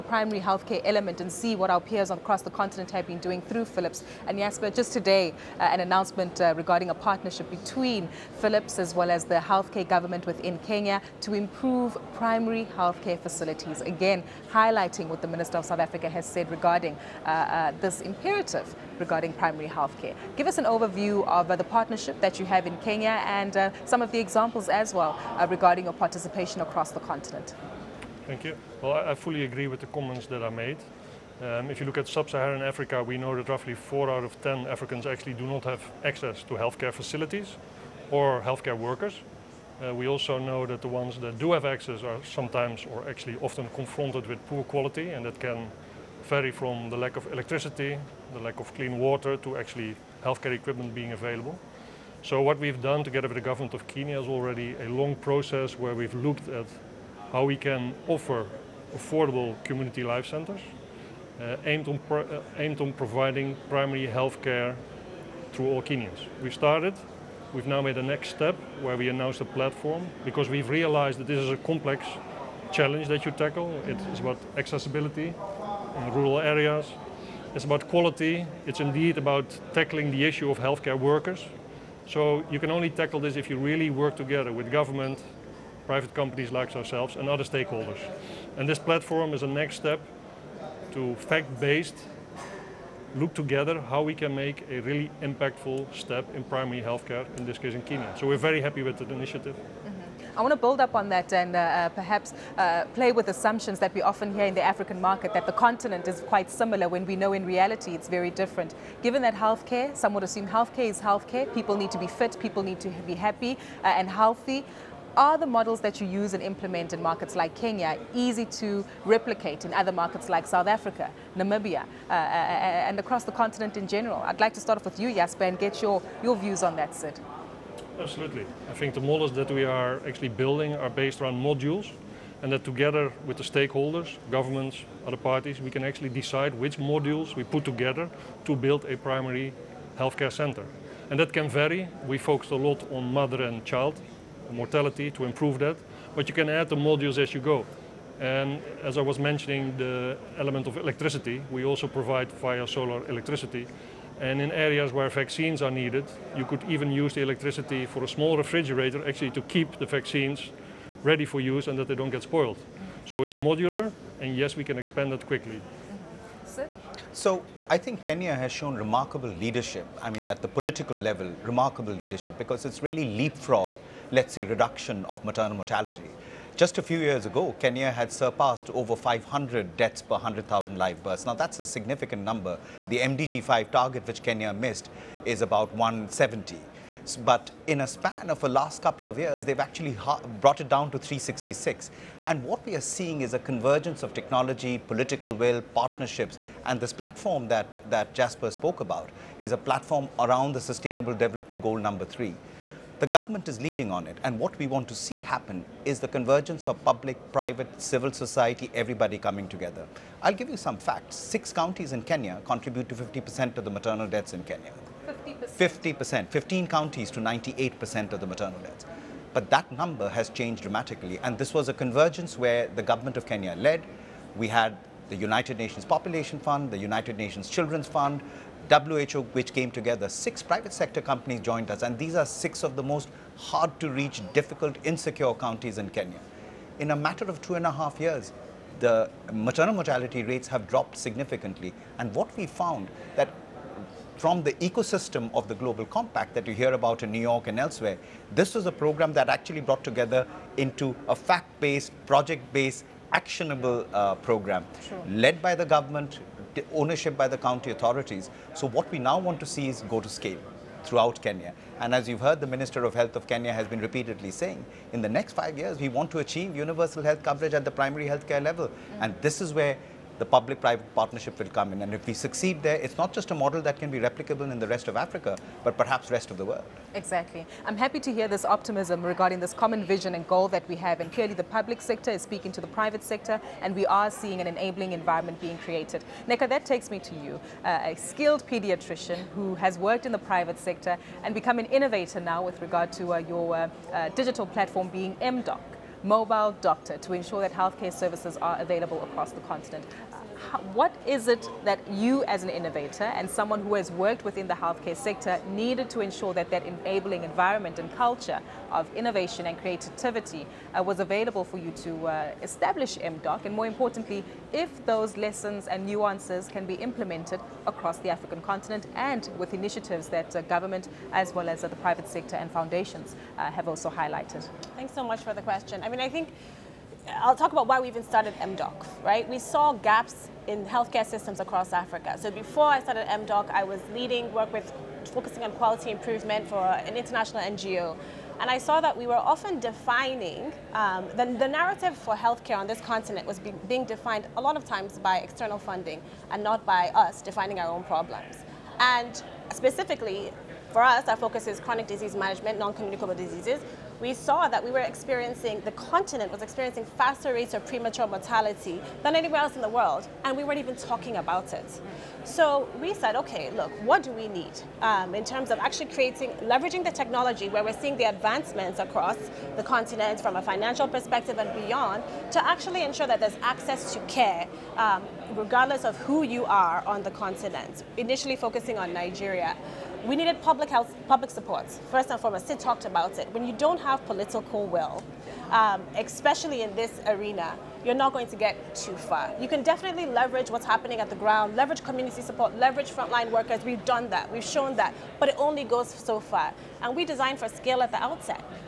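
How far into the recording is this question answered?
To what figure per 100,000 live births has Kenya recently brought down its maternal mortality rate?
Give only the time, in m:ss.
3:10.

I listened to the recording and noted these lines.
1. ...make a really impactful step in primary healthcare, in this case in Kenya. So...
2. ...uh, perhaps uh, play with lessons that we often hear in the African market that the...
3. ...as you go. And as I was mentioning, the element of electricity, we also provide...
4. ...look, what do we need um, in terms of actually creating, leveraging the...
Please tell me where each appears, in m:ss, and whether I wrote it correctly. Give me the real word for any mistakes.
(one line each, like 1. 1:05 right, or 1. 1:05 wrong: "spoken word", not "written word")
1. 1:34 right
2. 1:41 wrong: "assumptions", not "lessons"
3. 2:27 right
4. 6:03 right.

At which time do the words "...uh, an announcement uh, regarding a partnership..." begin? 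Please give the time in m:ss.
0:05.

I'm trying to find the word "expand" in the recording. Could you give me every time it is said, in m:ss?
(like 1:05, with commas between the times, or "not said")
2:44.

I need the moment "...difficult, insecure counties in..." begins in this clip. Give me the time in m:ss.
3:54.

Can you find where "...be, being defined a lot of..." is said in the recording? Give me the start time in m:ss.
5:43.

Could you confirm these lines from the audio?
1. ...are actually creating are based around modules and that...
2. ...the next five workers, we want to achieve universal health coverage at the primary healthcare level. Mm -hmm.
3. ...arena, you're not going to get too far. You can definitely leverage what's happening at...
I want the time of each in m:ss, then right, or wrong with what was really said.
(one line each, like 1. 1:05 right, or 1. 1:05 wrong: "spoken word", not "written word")
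1. 2:09 wrong: "building", not "creating"
2. 4:25 wrong: "years", not "workers"
3. 6:27 right.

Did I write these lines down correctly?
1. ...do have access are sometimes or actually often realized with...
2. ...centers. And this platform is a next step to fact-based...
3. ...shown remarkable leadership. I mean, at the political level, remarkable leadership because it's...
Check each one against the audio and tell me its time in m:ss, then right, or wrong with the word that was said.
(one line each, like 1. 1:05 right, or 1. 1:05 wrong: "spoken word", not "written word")
1. 0:41 wrong: "confronted", not "realized"
2. 1:27 wrong: "stakeholders", not "centers"
3. 2:48 right.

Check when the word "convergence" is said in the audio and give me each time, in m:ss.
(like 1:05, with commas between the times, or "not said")
3:13, 3:26, 3:41.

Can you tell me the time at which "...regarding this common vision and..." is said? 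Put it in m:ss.
4:39.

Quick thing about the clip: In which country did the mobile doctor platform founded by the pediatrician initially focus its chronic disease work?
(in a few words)
Nigeria.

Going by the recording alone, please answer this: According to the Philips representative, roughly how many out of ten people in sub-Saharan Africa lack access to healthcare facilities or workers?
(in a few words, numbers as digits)
4.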